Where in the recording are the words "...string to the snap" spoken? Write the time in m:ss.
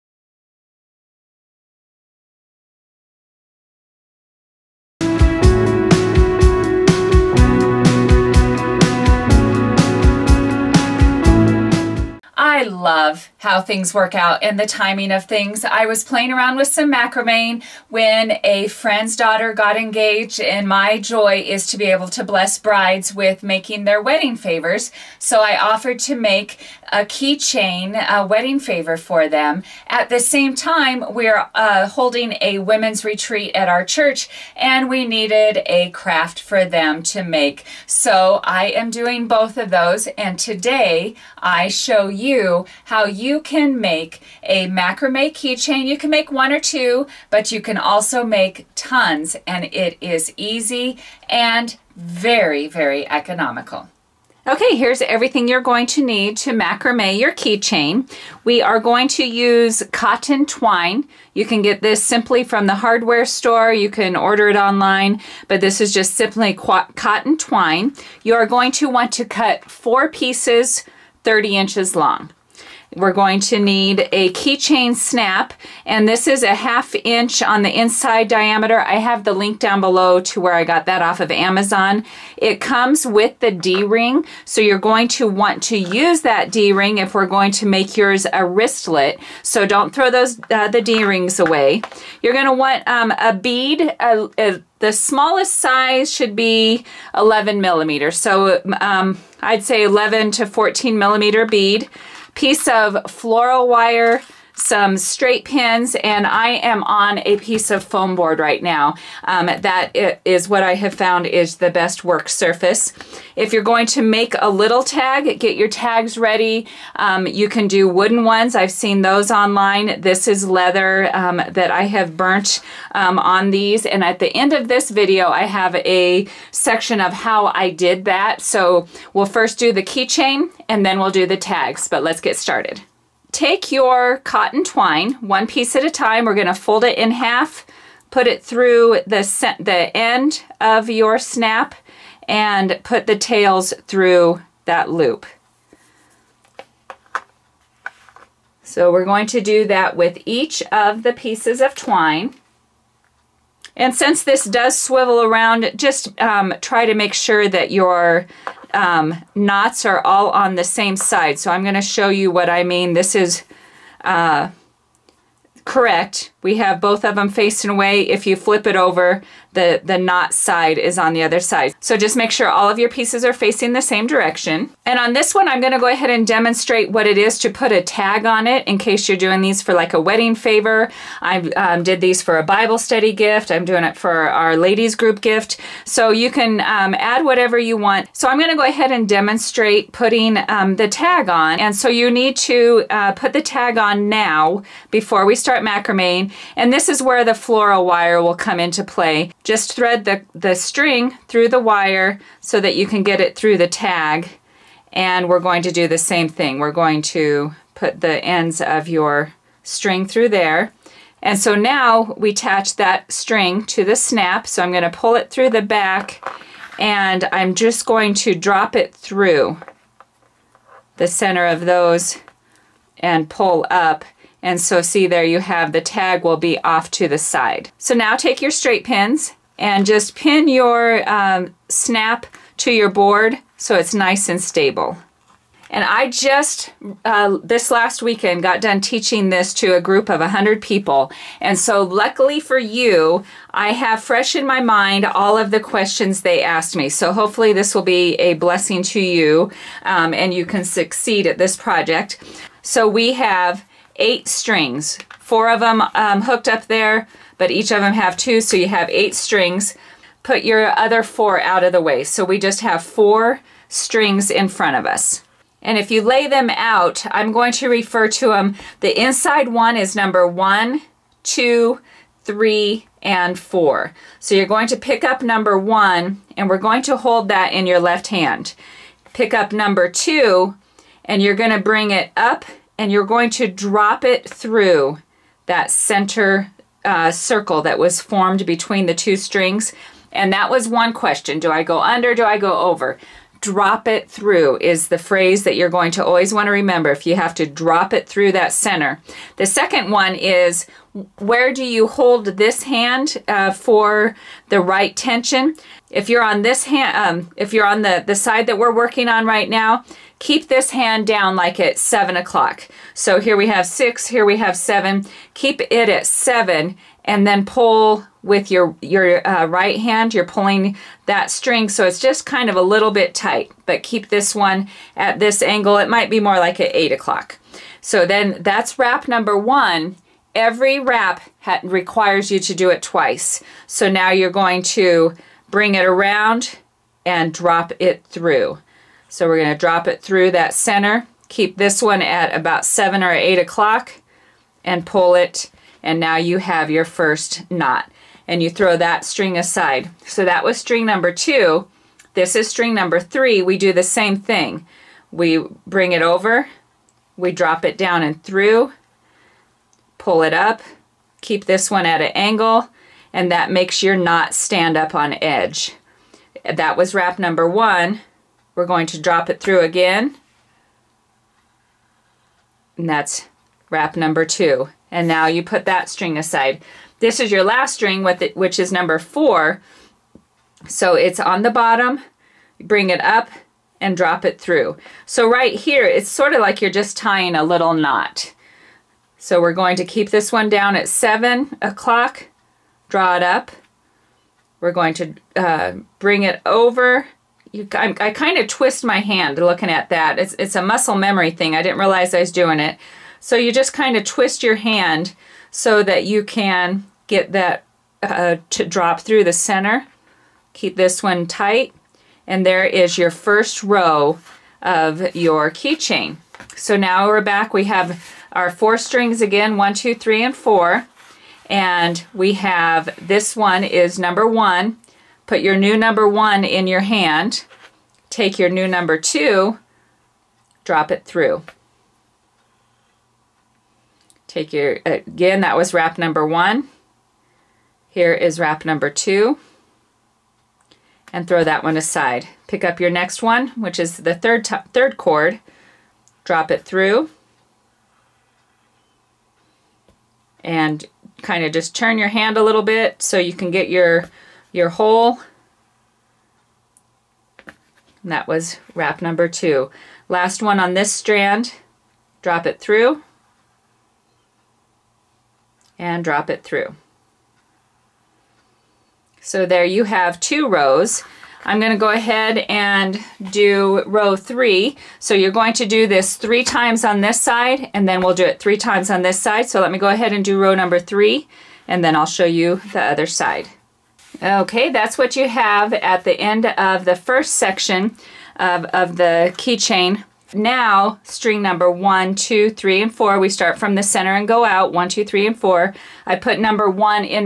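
3:33.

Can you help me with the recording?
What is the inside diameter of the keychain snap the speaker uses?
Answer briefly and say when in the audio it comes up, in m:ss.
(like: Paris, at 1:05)
half inch, at 1:16.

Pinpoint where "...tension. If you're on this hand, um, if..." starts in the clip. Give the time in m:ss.
5:04.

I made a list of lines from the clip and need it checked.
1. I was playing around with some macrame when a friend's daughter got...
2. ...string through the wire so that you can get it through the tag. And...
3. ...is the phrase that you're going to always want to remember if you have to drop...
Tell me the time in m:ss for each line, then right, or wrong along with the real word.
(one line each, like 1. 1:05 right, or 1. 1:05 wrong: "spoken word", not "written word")
1. 0:15 right
2. 3:20 right
3. 4:54 right.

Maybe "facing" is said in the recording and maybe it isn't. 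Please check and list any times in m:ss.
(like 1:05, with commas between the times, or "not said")
2:47, 2:53.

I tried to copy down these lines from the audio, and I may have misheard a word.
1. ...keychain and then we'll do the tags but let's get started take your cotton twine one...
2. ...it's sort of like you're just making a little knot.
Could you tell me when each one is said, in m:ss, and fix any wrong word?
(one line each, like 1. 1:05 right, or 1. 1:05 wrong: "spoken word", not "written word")
1. 2:09 right
2. 6:25 wrong: "tying", not "making".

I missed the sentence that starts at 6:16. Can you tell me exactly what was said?
This is your last string, it, which is number four.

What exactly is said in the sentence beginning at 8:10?
Now, string number one, two, three, and 4, we start from the center and go out, One, two, three, and 4.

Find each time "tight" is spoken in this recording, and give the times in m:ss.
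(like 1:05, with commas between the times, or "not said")
5:23, 6:51.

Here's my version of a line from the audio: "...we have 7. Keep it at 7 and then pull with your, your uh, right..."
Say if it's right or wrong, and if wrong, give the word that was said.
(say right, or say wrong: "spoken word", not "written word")
right.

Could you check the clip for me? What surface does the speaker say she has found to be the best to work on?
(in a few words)
foam board.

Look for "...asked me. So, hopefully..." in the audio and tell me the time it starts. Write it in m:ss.
4:06.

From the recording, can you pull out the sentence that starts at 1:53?
If you're going to make a little tag, get your tags ready.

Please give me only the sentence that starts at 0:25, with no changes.
So I offered to make a keychain, a wedding favor for them.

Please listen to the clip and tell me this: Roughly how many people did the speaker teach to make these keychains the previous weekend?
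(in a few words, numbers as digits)
100.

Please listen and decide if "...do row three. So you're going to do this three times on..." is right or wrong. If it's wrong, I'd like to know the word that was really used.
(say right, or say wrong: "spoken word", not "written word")
right.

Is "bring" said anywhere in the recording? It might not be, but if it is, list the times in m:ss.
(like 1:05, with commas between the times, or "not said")
4:41, 5:35, 5:55, 6:22, 6:35.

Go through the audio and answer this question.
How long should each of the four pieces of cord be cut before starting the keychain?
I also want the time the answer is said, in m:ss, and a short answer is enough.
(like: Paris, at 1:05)
30 inches, at 1:11.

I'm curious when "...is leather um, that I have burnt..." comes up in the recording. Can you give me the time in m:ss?
2:00.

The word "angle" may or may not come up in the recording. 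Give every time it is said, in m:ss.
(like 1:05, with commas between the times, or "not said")
5:25, 6:02.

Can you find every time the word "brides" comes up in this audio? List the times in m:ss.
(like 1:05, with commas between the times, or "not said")
0:22.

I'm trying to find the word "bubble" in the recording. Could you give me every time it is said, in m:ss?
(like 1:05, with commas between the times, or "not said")
not said.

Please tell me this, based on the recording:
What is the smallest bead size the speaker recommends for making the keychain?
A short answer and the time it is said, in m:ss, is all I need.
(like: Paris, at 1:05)
11 millimeters, at 1:37.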